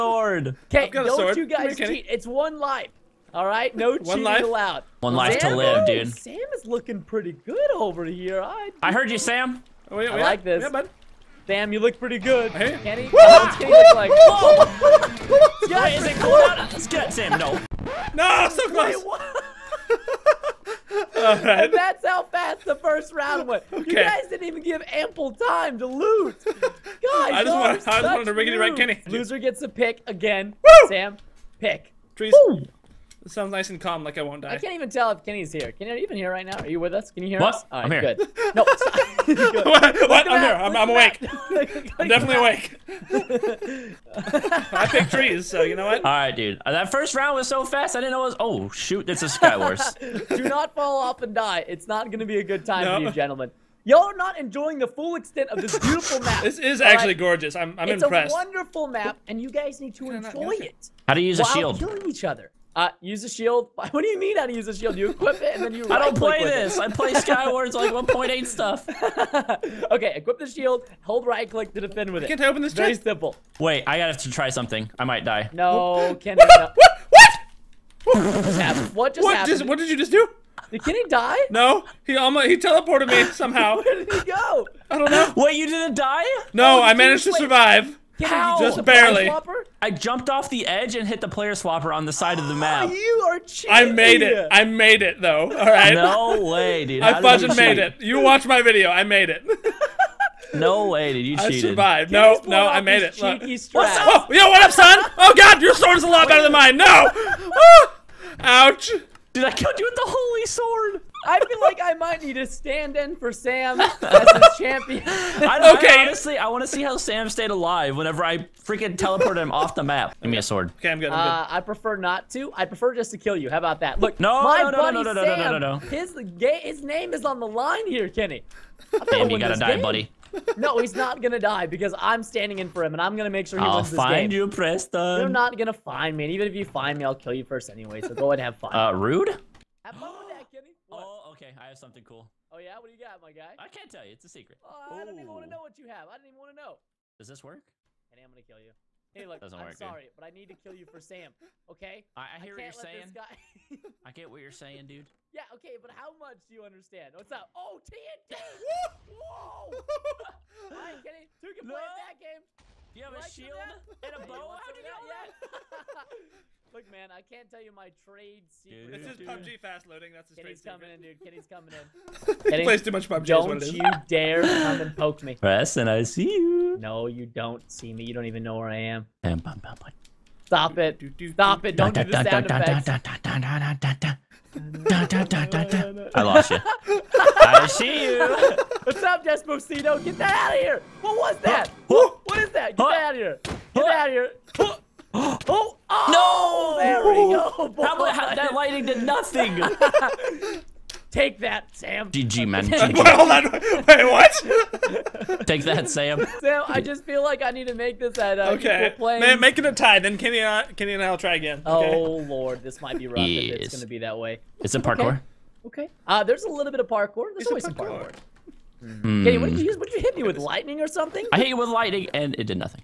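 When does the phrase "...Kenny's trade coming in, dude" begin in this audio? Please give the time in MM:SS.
02:50.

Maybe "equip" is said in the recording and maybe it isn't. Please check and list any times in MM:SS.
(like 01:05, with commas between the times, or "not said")
01:05, 01:10.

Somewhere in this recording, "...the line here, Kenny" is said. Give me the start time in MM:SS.
02:07.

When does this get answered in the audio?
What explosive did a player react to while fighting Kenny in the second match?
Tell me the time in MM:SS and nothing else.
02:37.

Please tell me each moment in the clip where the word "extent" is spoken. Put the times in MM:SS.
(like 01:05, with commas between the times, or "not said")
00:55.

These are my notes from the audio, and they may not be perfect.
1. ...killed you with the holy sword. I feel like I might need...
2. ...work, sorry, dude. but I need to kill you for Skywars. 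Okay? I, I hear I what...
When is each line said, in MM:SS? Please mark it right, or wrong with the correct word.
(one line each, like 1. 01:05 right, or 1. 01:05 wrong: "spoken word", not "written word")
1. 01:49 right
2. 02:29 wrong: "Sam", not "Skywars".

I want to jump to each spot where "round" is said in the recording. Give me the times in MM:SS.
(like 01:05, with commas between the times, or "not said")
00:23, 00:47.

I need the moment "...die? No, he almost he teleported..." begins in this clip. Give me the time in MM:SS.
01:21.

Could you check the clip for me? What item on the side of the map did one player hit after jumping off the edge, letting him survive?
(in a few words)
Player swapper.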